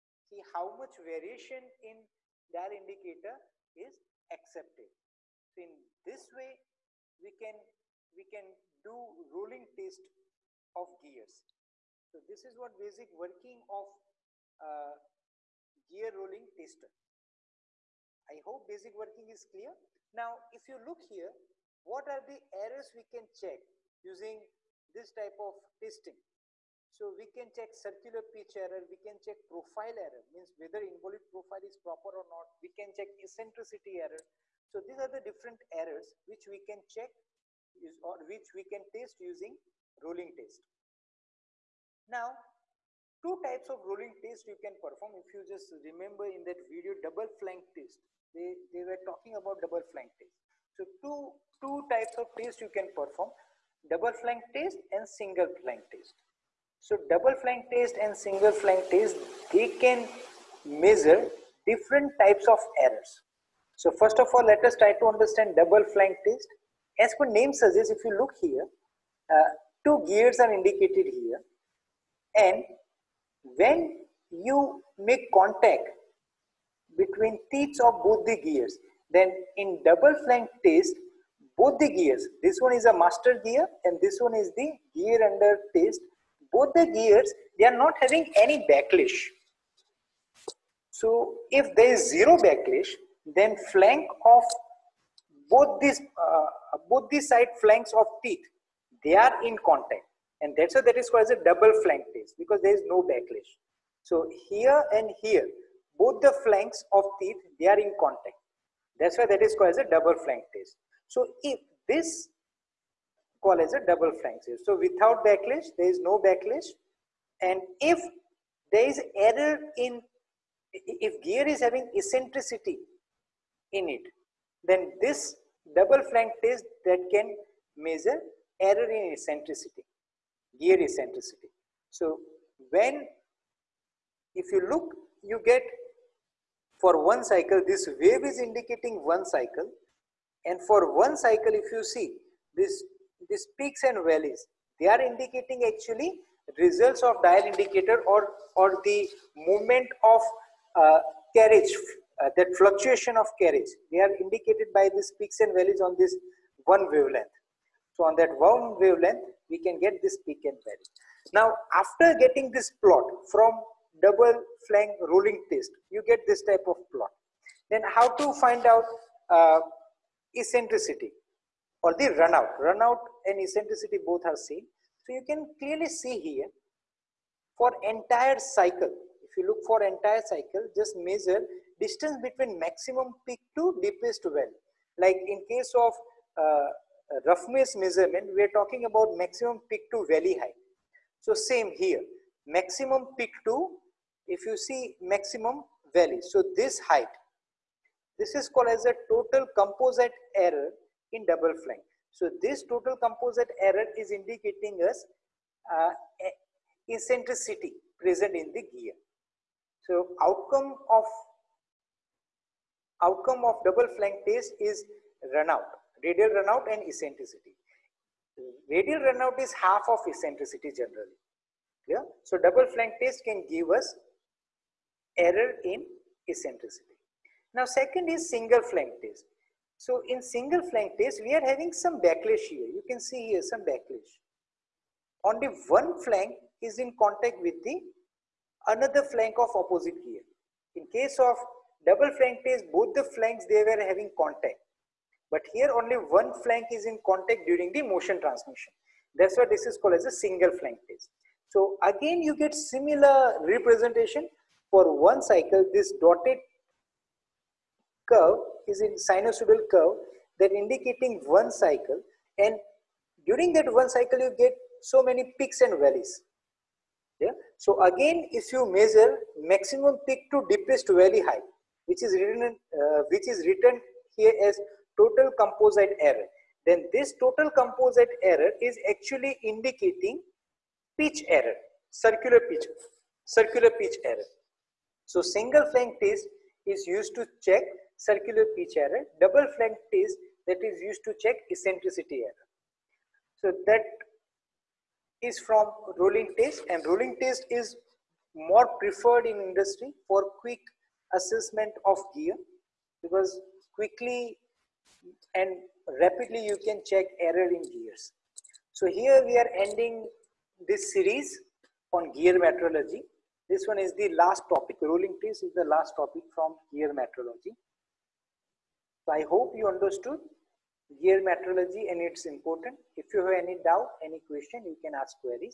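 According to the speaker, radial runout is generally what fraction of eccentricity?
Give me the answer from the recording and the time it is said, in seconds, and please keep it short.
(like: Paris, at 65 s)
Half, at 219 s.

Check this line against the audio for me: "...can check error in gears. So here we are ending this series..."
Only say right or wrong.
right.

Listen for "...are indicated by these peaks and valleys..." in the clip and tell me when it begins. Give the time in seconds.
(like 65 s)
153 s.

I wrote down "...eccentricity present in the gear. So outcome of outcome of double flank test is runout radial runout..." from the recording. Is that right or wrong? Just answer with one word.
right.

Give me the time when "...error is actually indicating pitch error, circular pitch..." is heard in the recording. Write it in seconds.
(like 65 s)
278 s.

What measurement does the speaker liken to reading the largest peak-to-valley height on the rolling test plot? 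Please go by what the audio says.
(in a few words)
Roughness measurement.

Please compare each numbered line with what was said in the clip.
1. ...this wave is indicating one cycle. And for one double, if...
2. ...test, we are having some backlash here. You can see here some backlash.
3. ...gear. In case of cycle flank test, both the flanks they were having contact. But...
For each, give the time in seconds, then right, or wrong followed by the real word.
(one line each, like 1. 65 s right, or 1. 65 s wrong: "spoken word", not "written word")
1. 137 s wrong: "cycle", not "double"
2. 230 s right
3. 240 s wrong: "double", not "cycle".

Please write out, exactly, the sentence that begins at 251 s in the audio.
So again, you get similar representation for one cycle.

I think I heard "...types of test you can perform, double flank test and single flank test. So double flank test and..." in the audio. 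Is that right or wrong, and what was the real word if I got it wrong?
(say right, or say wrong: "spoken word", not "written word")
right.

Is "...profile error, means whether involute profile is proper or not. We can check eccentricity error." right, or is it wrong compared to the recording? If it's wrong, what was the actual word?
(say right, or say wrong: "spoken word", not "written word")
right.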